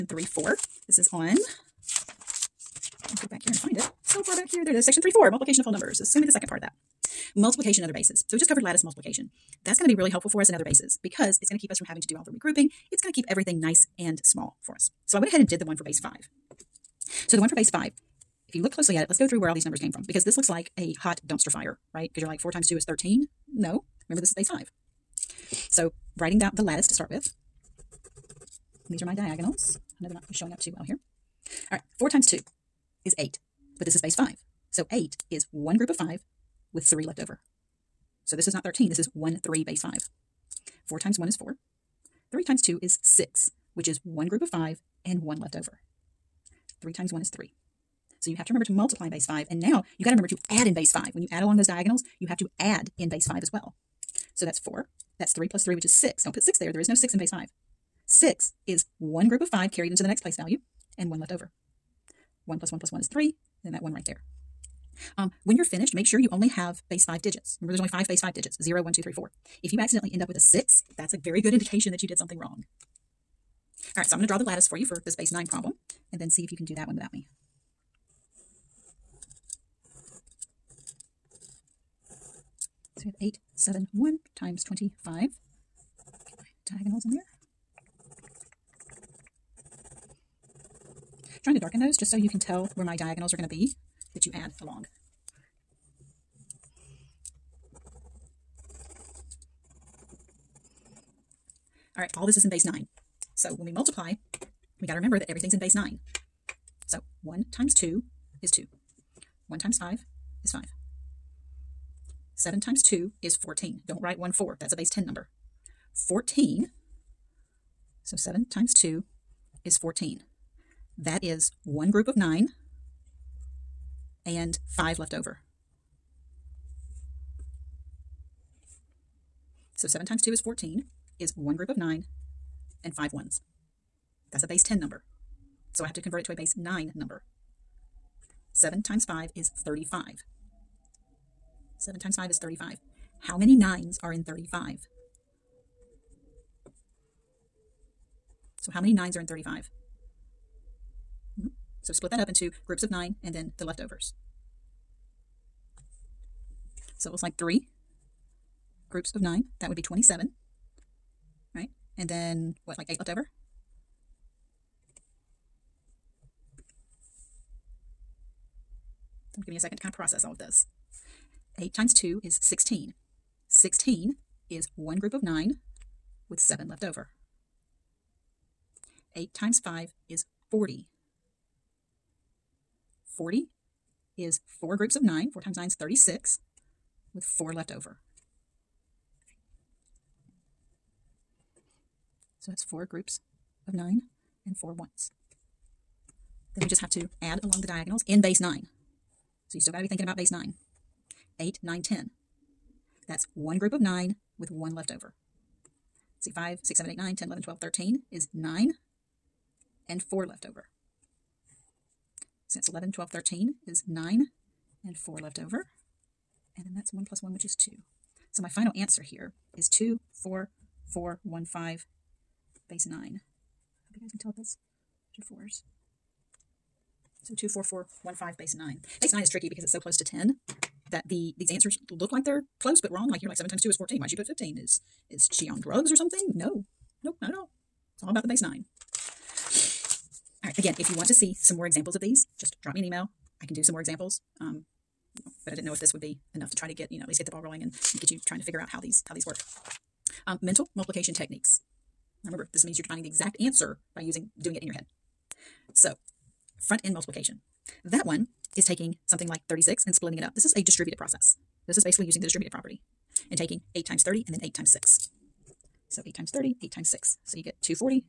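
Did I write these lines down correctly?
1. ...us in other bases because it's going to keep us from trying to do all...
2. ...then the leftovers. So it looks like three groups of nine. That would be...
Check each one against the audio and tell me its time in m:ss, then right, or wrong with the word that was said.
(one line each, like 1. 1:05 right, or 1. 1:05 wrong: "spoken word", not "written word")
1. 0:10 wrong: "having", not "trying"
2. 2:33 right.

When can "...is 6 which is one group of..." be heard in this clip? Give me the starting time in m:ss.
0:42.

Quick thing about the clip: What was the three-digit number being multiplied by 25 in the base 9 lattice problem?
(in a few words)
871.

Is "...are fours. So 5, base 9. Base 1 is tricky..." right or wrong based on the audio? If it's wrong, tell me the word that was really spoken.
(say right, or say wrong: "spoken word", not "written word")
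wrong: "9", not "1".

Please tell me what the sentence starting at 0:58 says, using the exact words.
6 is one group of five carried into the next place value, and one left over.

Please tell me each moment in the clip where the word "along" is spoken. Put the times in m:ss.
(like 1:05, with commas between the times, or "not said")
0:51, 1:34, 3:17.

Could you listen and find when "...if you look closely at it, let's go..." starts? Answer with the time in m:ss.
0:18.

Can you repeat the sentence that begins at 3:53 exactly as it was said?
Like you're like seven times two is fourteen.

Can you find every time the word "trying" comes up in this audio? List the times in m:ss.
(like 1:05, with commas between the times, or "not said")
1:31, 4:08.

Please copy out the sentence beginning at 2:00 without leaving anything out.
That is one group of 9 and five left over.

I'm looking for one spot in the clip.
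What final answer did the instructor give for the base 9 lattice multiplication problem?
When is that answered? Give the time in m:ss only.
3:39.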